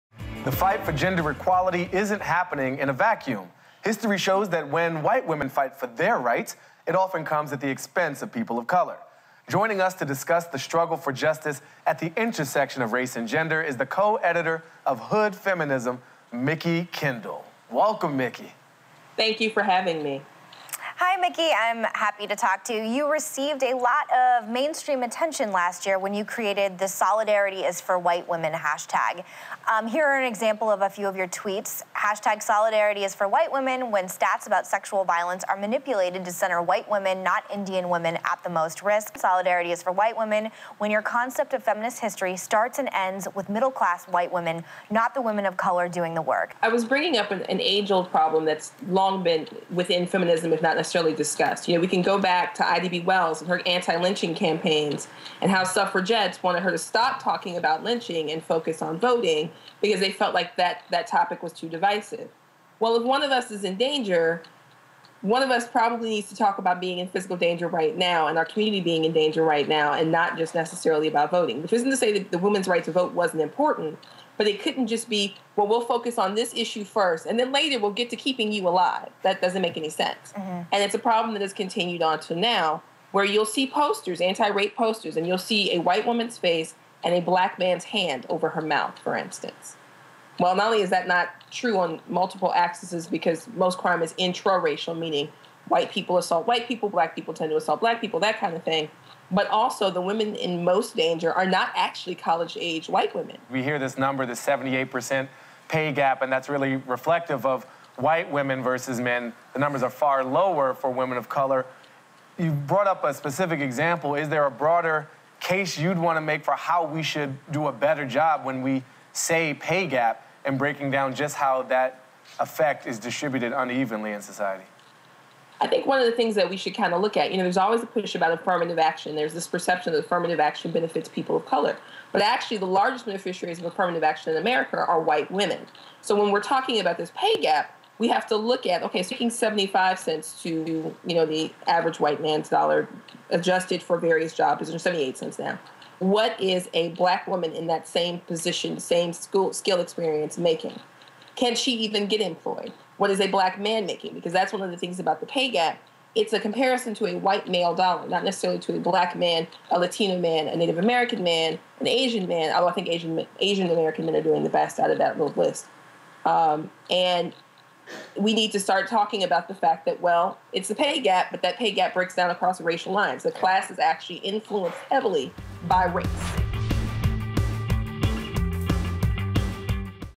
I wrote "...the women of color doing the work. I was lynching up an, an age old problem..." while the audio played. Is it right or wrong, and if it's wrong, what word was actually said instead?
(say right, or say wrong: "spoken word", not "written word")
wrong: "bringing", not "lynching".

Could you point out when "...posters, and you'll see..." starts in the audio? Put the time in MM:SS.
01:24.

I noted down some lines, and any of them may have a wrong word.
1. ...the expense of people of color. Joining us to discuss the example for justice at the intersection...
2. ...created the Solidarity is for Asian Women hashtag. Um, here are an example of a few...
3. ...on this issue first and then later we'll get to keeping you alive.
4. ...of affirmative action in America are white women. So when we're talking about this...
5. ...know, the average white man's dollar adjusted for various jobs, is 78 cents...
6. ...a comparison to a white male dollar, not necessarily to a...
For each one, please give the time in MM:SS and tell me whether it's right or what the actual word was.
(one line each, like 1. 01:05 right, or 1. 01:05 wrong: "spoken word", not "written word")
1. 00:07 wrong: "struggle", not "example"
2. 00:26 wrong: "White", not "Asian"
3. 01:16 right
4. 02:13 right
5. 02:21 right
6. 02:36 right.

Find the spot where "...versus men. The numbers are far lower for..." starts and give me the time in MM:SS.
01:48.